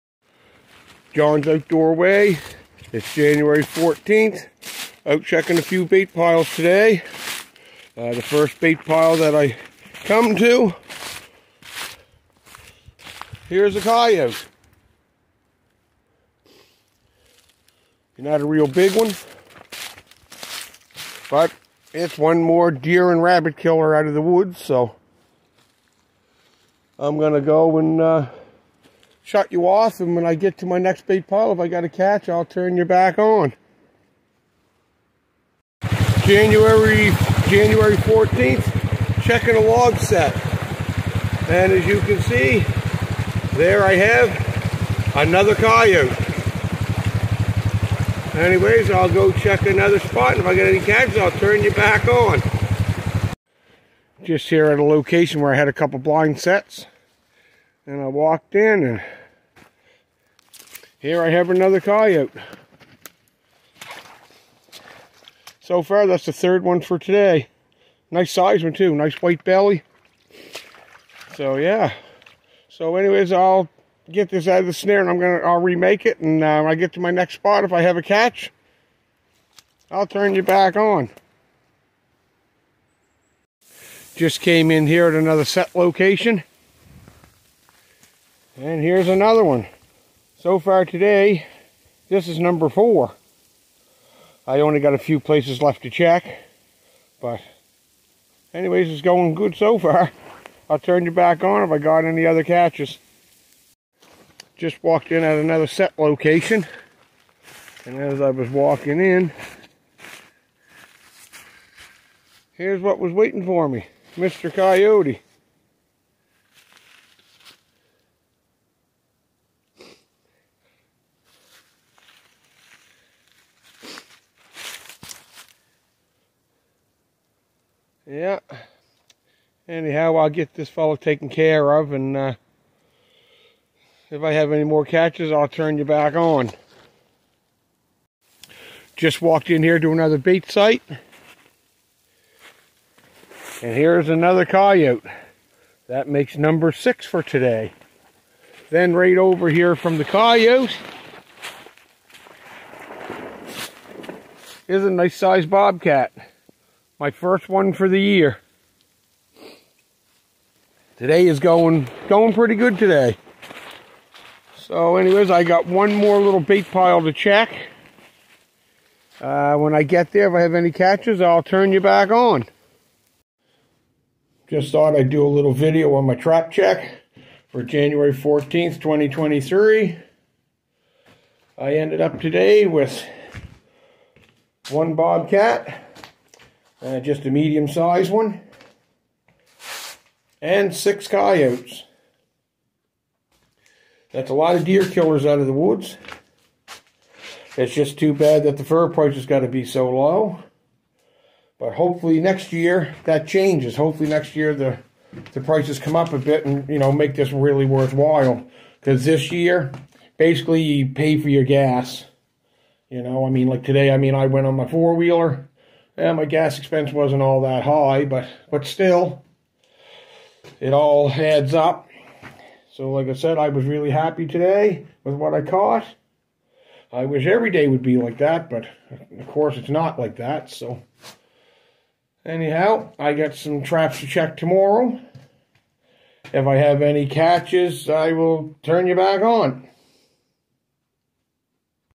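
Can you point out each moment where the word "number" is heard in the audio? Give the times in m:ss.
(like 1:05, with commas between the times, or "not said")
1:32, 2:26.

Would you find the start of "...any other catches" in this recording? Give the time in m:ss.
1:42.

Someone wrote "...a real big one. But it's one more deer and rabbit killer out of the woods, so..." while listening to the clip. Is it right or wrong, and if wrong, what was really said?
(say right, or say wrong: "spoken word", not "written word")
right.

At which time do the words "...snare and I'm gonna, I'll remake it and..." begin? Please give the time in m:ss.
1:14.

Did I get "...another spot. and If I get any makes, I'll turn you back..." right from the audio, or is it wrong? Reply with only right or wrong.
wrong.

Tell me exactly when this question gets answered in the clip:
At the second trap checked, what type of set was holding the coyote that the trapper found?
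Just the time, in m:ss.
0:39.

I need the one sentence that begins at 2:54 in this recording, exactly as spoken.
Just thought I'd do a little video on my trap check for January 14th, 2023.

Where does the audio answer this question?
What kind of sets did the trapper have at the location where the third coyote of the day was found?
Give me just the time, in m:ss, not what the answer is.
0:55.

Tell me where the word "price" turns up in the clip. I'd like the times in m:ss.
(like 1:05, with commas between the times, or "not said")
3:18, 3:25.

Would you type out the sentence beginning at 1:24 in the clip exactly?
Just came in here at another set location.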